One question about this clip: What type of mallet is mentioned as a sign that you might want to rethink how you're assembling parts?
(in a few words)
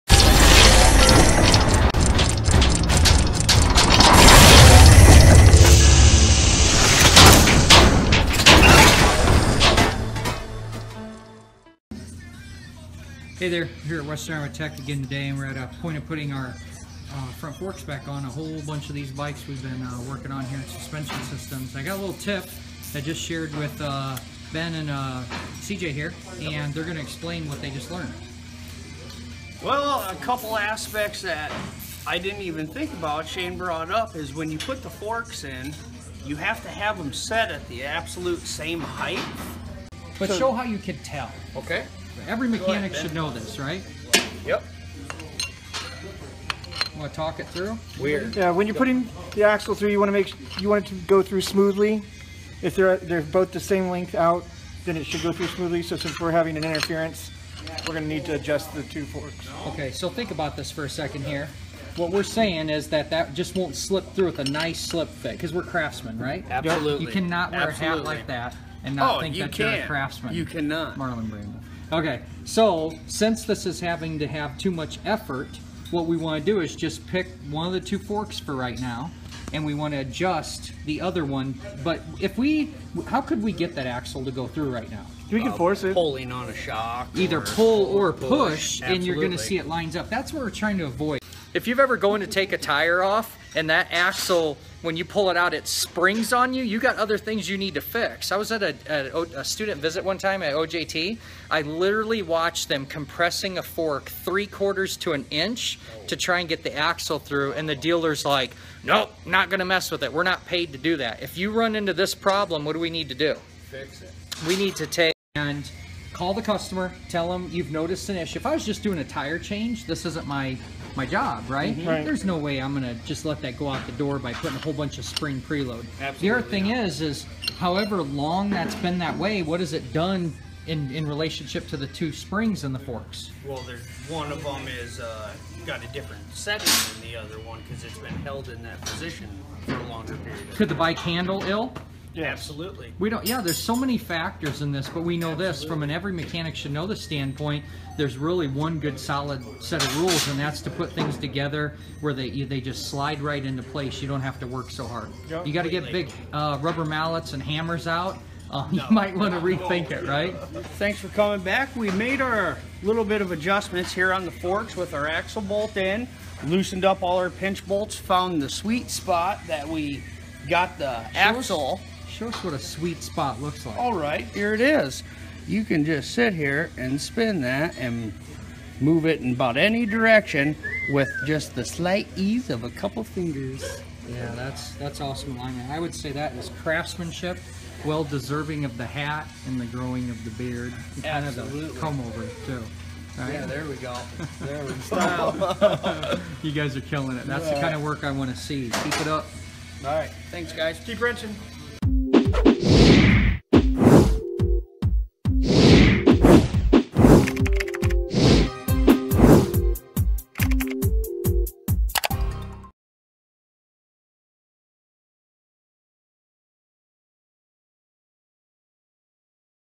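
Rubber.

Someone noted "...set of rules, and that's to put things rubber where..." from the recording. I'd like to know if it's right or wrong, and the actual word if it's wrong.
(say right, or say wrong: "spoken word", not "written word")
wrong: "together", not "rubber".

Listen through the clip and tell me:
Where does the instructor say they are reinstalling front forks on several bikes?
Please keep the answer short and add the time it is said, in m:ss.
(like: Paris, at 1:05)
Western Armour Tech, at 0:14.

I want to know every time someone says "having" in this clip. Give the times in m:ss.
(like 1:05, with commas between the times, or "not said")
0:56, 1:13.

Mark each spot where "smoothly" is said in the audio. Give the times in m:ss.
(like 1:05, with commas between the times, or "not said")
0:51, 0:55.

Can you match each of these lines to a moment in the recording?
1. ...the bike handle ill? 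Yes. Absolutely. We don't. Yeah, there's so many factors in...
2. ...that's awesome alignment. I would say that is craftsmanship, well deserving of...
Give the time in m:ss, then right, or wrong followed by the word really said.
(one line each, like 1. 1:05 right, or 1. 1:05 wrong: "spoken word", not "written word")
1. 2:20 right
2. 3:04 right.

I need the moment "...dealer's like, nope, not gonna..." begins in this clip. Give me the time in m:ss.
1:47.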